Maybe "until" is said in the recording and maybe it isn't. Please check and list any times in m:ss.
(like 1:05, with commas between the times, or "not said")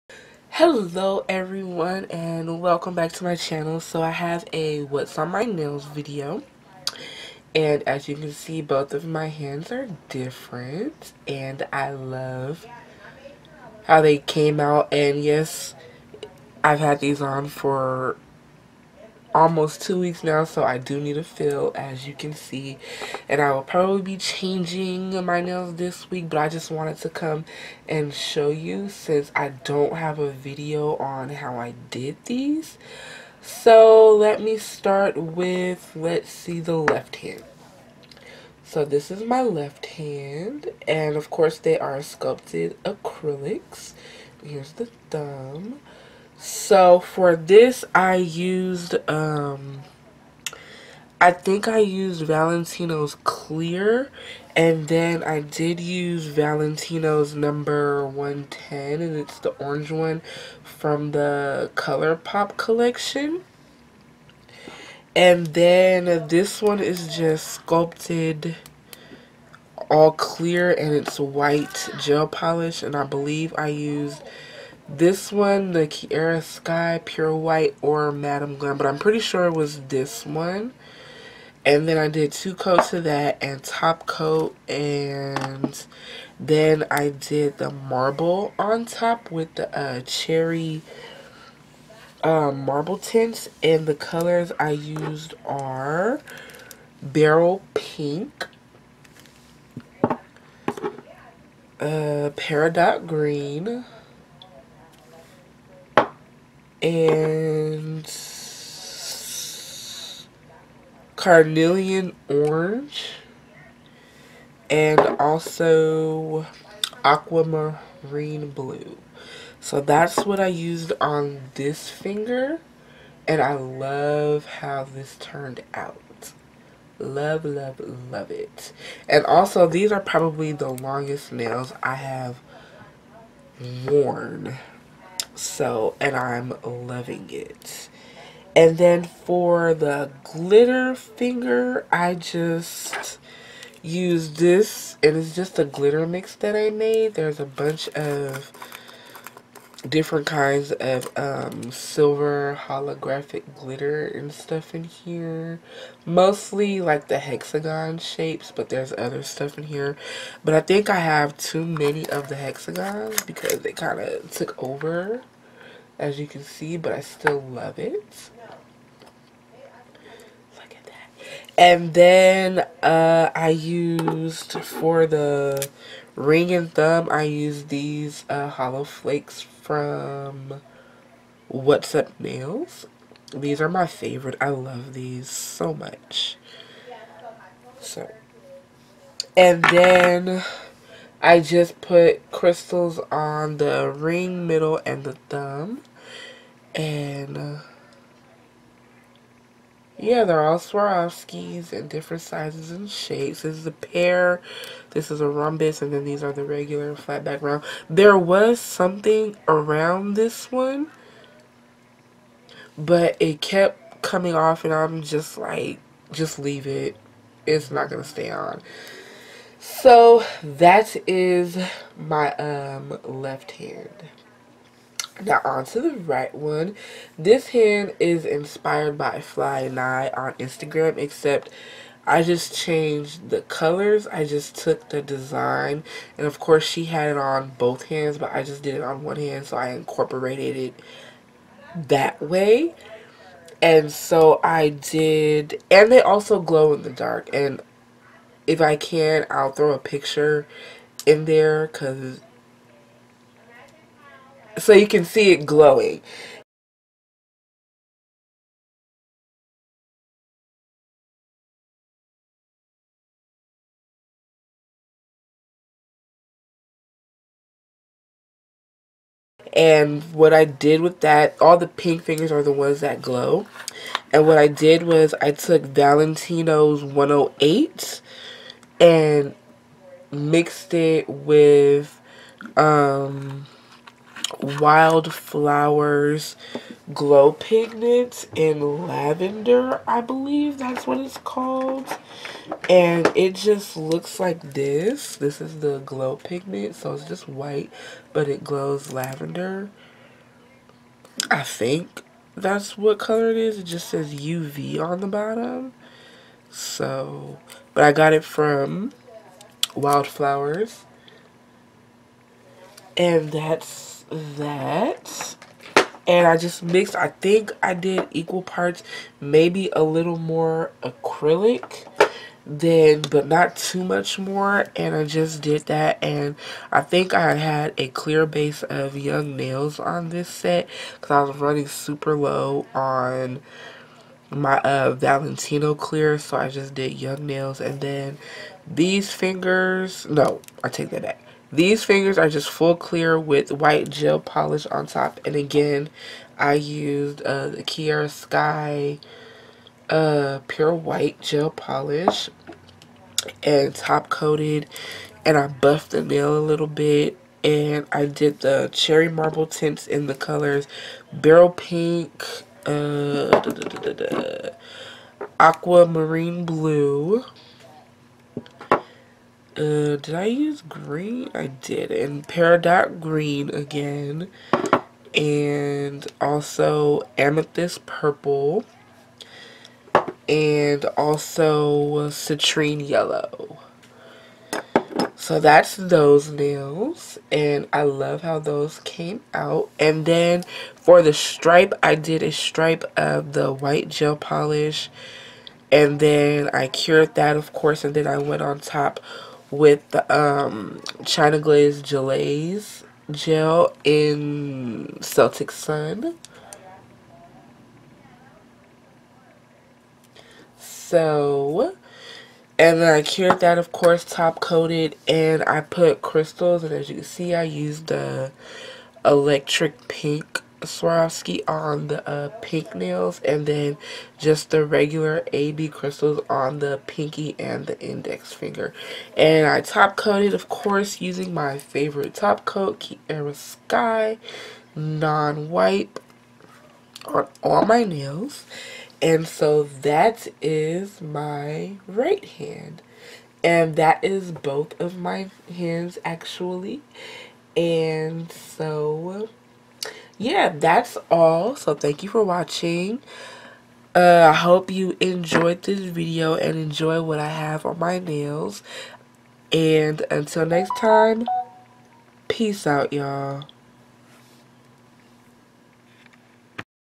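7:40.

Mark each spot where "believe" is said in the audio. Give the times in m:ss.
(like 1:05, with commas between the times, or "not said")
1:13, 4:50.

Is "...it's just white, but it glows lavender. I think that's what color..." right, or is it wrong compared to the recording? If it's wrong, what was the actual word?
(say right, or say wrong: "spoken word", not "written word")
right.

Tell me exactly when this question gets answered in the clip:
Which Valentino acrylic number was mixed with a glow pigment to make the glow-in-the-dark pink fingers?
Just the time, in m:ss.
4:36.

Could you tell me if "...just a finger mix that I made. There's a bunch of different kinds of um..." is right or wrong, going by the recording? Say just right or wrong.
wrong.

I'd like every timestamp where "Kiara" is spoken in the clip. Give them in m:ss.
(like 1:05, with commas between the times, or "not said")
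1:15, 5:47, 7:12.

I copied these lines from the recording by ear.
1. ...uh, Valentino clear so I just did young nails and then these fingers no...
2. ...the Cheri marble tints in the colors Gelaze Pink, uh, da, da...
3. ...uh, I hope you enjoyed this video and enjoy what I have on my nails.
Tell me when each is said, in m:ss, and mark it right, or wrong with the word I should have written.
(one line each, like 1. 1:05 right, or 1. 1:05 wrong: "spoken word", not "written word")
1. 5:34 right
2. 5:58 wrong: "Beryl", not "Gelaze"
3. 7:33 right.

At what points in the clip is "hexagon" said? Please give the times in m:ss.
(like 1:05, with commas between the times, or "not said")
2:37, 2:42.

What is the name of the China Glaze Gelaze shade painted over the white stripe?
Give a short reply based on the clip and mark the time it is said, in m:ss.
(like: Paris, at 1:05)
Celtic Sun, at 6:45.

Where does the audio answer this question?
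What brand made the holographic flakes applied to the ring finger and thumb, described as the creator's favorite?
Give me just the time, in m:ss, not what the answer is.
3:01.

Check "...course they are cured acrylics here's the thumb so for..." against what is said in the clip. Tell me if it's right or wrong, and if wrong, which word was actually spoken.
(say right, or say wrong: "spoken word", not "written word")
wrong: "sculpted", not "cured".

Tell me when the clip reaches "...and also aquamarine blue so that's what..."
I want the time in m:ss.
1:54.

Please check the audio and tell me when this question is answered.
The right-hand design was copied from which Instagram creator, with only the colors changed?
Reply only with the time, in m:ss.
3:49.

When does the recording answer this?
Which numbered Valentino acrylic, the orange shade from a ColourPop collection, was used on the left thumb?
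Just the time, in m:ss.
0:57.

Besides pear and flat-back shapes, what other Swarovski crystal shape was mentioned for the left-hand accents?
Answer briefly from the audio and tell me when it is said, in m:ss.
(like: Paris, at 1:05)
rhombus, at 3:25.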